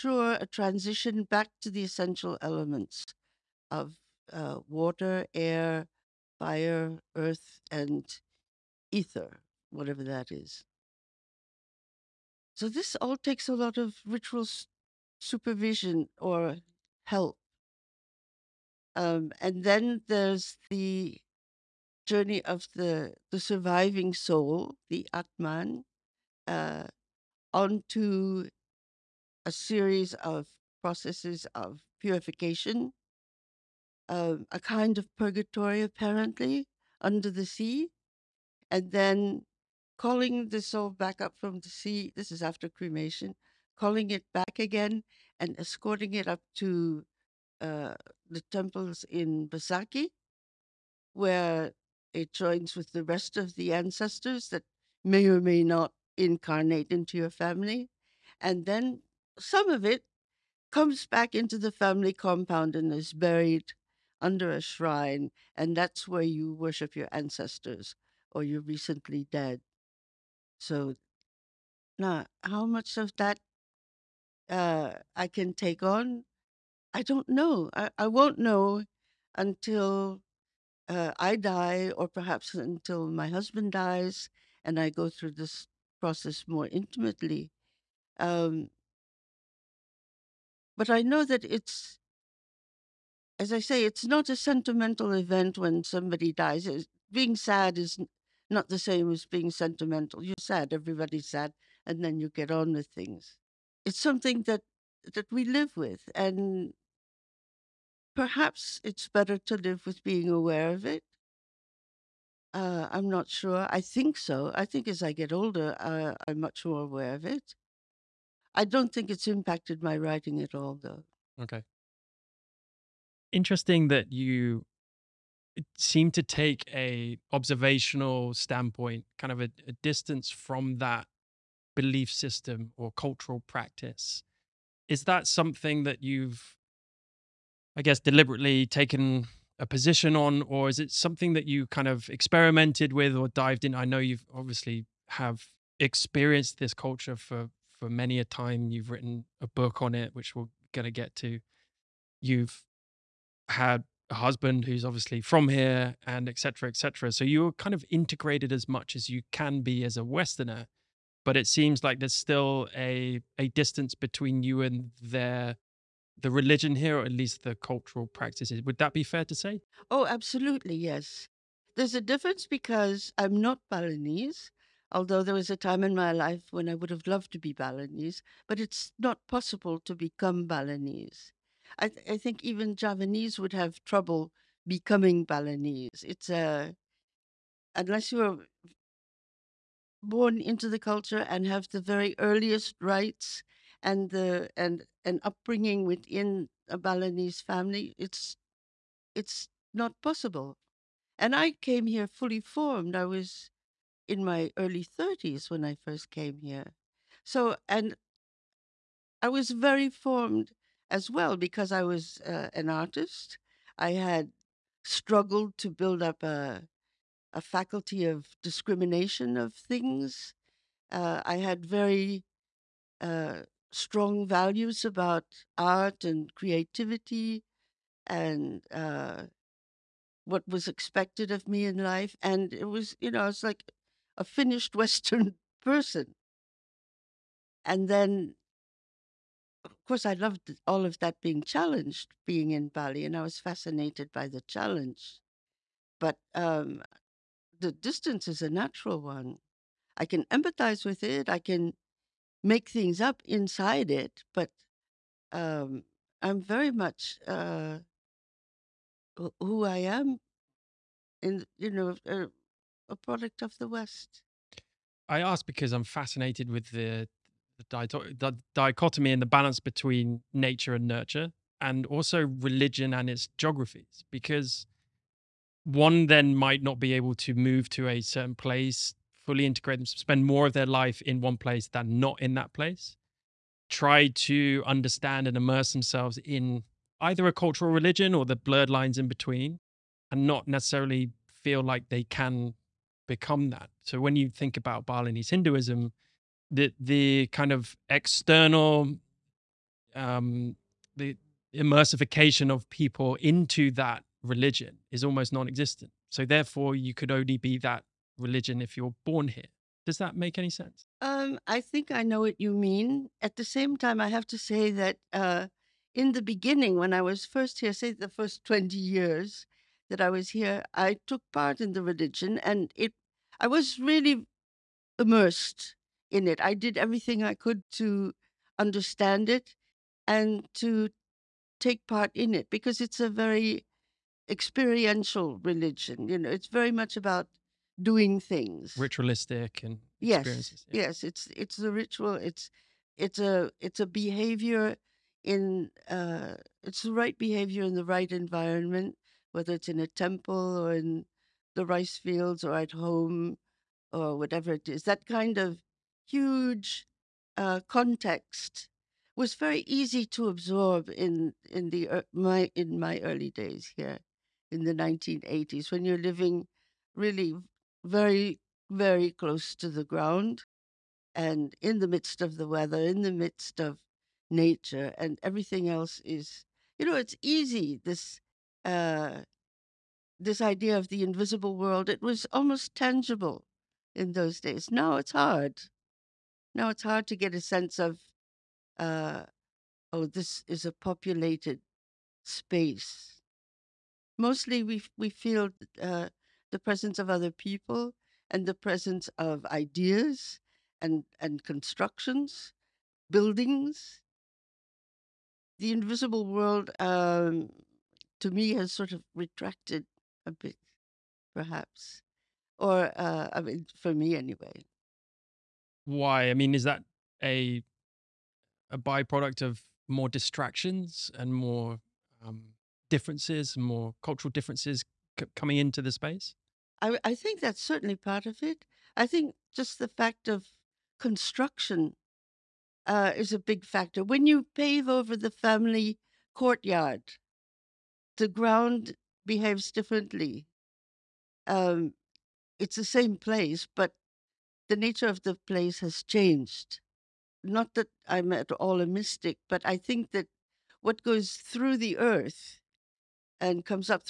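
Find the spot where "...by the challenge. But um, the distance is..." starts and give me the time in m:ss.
4:04.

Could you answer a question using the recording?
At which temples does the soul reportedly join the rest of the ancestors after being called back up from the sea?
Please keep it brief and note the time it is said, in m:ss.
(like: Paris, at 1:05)
Besakih, at 0:49.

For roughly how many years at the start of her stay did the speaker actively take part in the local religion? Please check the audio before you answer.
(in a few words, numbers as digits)
20.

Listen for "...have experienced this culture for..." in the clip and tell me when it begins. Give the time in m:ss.
2:25.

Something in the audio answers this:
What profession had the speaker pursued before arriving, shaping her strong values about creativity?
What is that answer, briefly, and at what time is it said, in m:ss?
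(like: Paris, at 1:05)
Artist, at 3:32.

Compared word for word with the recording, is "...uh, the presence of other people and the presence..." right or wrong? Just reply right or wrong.
right.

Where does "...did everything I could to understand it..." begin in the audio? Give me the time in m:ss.
5:26.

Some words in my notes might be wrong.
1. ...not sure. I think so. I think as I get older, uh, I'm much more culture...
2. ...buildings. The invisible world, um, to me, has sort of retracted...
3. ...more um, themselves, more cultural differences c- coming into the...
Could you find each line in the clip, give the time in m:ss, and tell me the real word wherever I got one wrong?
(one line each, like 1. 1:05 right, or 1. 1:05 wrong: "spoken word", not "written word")
1. 1:53 wrong: "aware", not "culture"
2. 6:43 right
3. 7:01 wrong: "differences", not "themselves".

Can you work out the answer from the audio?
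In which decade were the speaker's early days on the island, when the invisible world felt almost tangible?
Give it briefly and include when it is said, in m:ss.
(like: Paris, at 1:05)
1980s, at 6:04.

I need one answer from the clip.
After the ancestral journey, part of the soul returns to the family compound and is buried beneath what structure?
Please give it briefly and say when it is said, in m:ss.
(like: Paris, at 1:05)
A shrine, at 1:04.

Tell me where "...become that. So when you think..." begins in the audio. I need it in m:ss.
4:53.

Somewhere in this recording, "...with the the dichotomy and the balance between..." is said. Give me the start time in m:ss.
4:26.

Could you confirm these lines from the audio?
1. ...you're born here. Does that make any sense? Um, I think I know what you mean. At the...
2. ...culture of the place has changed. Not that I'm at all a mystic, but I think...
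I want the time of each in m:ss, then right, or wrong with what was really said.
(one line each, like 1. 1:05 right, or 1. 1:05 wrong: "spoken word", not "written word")
1. 5:08 right
2. 7:24 wrong: "nature", not "culture".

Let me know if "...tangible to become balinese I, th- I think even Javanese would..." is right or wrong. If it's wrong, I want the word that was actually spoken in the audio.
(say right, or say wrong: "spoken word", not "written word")
wrong: "possible", not "tangible".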